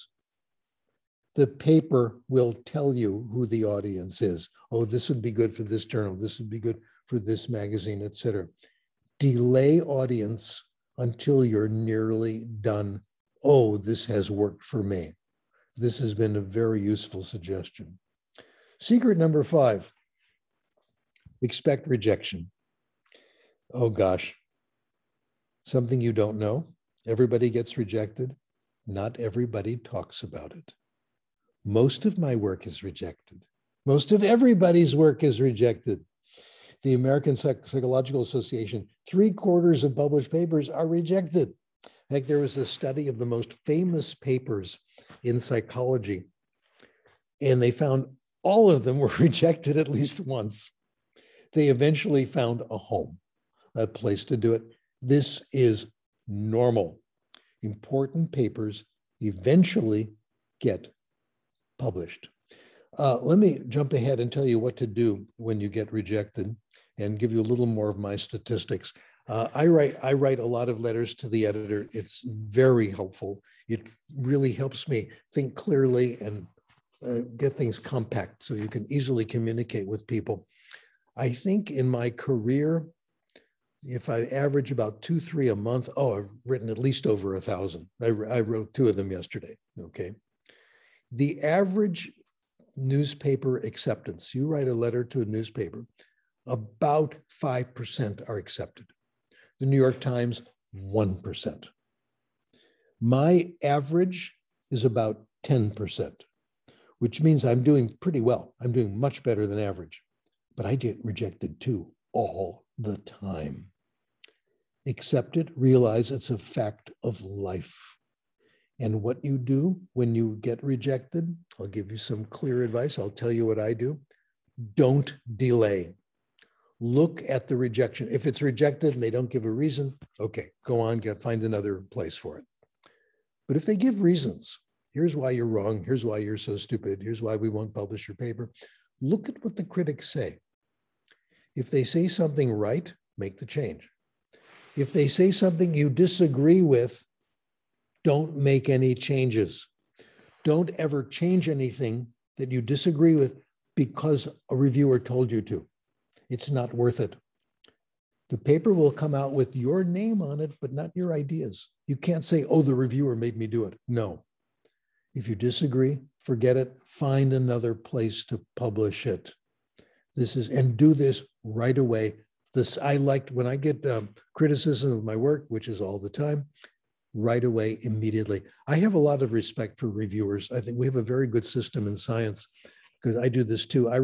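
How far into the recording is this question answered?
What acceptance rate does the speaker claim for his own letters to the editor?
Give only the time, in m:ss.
1:45.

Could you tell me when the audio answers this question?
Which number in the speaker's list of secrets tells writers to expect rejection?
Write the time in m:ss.
0:18.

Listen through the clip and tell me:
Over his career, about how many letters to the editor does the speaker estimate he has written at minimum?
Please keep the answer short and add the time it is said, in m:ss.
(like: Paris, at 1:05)
over 1000, at 1:27.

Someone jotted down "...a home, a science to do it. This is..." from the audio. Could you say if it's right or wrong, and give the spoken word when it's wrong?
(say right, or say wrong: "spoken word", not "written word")
wrong: "place", not "science".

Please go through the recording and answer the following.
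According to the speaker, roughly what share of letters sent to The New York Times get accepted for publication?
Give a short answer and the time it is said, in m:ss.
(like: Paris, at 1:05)
1%, at 1:40.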